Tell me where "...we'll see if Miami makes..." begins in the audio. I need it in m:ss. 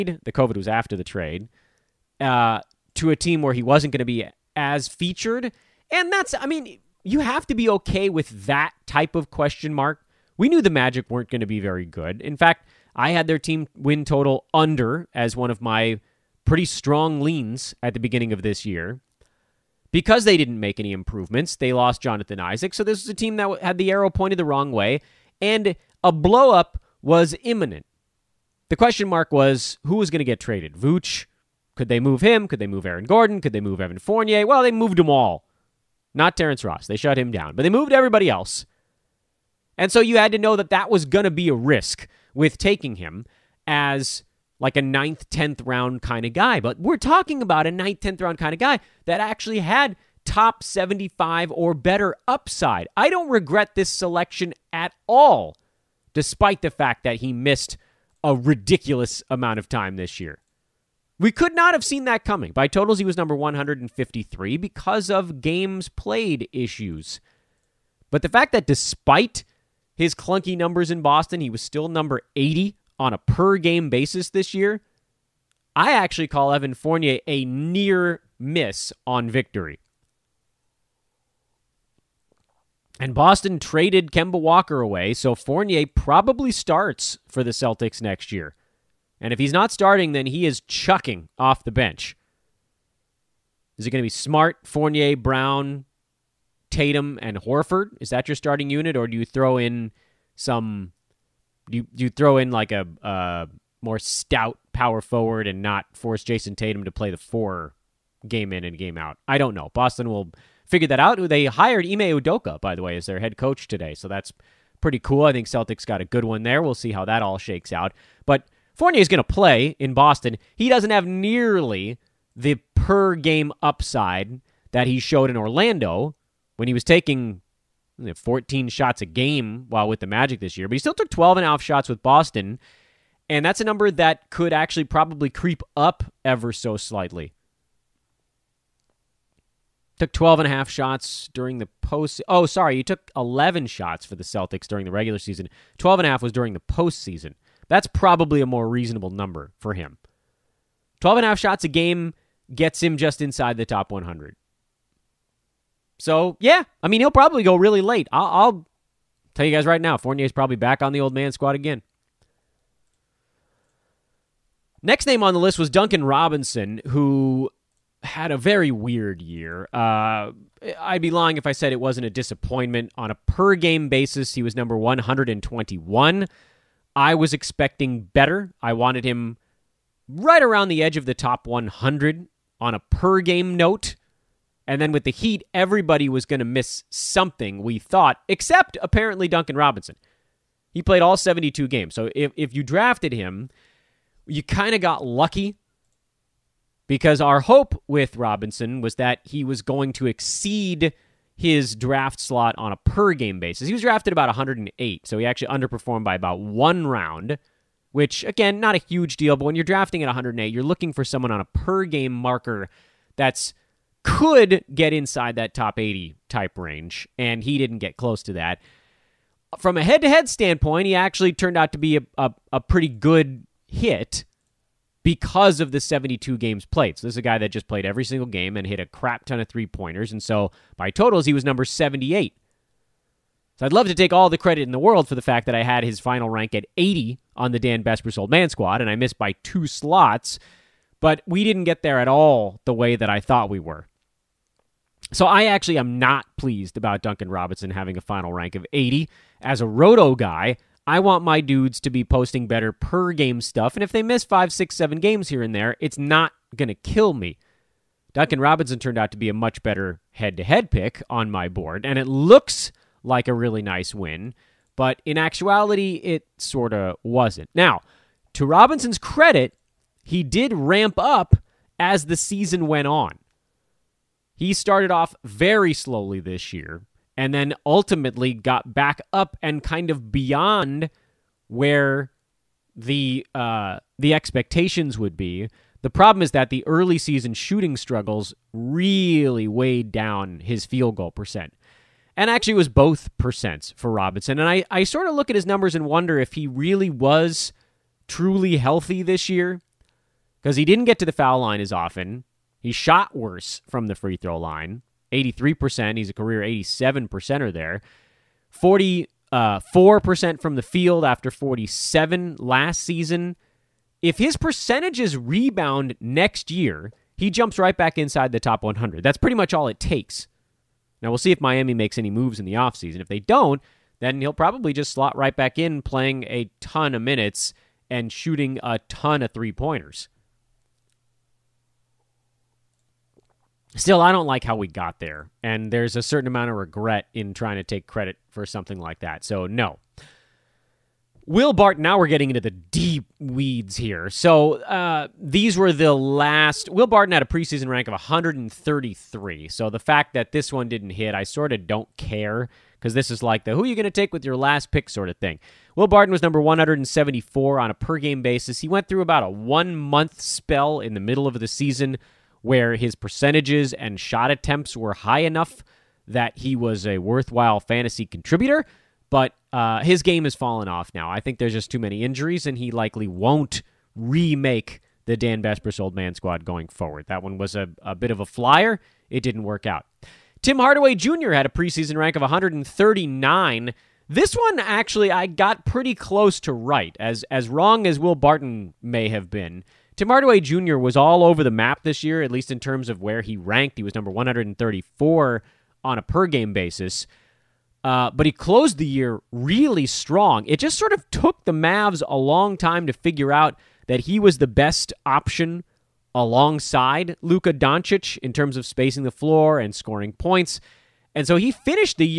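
5:21.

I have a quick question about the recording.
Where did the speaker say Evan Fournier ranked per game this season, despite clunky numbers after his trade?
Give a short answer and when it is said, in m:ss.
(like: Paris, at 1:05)
80, at 1:11.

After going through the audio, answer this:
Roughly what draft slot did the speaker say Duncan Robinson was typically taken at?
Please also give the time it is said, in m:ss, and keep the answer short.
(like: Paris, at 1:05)
108, at 3:24.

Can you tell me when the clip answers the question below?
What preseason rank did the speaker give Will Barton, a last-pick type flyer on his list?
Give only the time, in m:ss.
5:47.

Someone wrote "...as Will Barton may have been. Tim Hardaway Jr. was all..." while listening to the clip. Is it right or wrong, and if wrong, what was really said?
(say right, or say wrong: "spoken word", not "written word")
right.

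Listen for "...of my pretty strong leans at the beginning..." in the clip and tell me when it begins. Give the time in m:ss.
0:15.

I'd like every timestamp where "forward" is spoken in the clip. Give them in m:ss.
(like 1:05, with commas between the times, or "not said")
1:44, 6:16.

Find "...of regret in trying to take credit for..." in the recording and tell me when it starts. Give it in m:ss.
5:36.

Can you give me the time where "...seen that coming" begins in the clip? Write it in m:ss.
1:01.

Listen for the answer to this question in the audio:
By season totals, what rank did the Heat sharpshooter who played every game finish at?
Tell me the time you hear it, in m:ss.
3:51.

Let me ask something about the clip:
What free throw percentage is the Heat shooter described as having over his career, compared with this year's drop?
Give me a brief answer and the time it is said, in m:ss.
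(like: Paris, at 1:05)
87%, at 5:06.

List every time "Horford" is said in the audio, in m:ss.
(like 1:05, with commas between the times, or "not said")
1:37.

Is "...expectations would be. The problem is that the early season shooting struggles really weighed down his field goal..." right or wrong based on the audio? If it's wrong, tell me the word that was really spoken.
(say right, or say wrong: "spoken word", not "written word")
right.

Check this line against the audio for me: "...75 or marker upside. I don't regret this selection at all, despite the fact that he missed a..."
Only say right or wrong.
wrong.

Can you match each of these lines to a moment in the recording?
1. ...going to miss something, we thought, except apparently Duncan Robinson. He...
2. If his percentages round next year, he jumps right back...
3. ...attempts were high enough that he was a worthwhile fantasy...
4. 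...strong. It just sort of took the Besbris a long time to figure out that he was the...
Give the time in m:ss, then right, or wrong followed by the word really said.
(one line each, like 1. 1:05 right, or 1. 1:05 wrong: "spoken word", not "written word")
1. 3:06 right
2. 5:14 wrong: "rebound", not "round"
3. 6:04 right
4. 6:39 wrong: "Mavs", not "Besbris".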